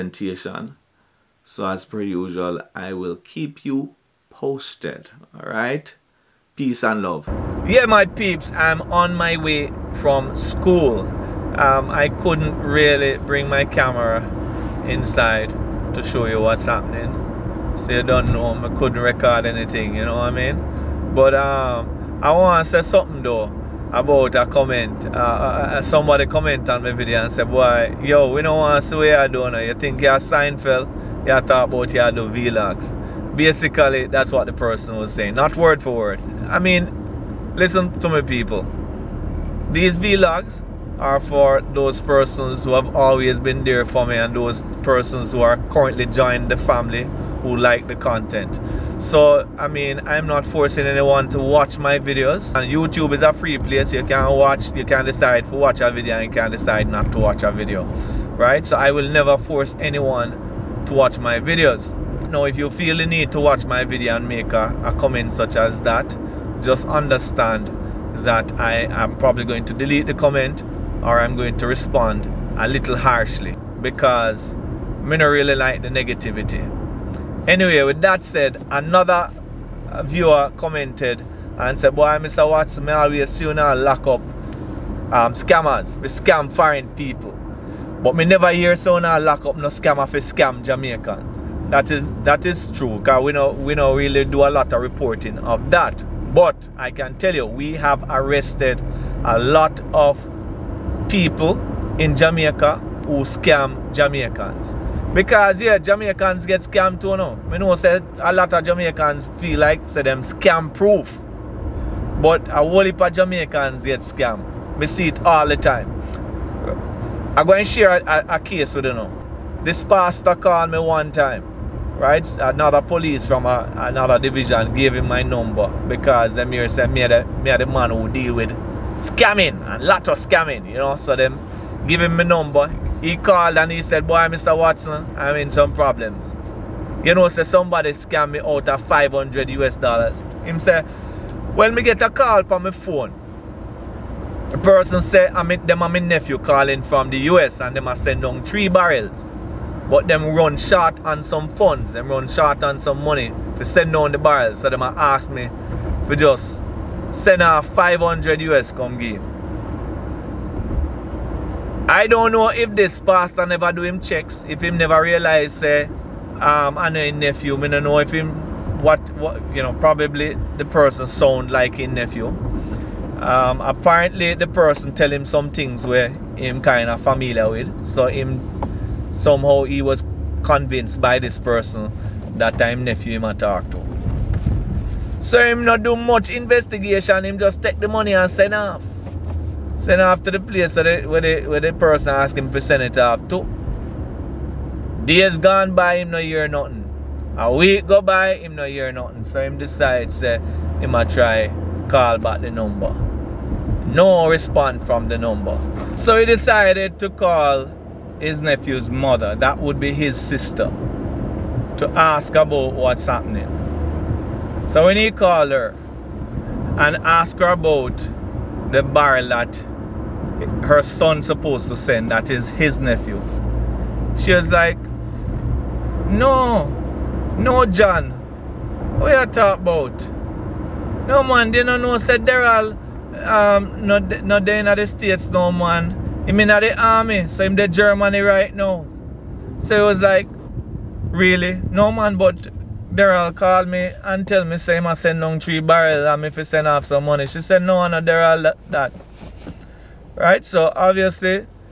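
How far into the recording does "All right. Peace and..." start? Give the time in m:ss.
0:05.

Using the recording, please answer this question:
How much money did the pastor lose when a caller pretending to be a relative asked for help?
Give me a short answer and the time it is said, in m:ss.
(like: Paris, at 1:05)
500 US dollars, at 2:18.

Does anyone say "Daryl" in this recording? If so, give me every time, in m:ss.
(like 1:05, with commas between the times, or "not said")
3:52, 4:02, 4:08.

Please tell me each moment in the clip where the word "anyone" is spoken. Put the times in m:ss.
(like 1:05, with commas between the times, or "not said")
0:50, 0:59.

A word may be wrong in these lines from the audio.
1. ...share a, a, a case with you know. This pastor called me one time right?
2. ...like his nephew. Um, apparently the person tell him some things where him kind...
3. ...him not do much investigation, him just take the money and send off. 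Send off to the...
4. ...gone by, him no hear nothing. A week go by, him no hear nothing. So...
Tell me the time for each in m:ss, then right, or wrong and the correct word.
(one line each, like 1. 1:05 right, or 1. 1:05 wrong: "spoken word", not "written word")
1. 1:57 right
2. 2:51 right
3. 3:05 right
4. 3:15 right.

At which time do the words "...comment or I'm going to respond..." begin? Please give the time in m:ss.
1:10.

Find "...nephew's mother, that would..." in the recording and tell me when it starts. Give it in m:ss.
3:28.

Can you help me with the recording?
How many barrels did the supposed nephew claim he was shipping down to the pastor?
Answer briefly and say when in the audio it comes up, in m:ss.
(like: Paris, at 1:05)
3, at 2:28.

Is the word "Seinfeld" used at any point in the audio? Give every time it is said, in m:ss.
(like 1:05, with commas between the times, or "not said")
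0:30.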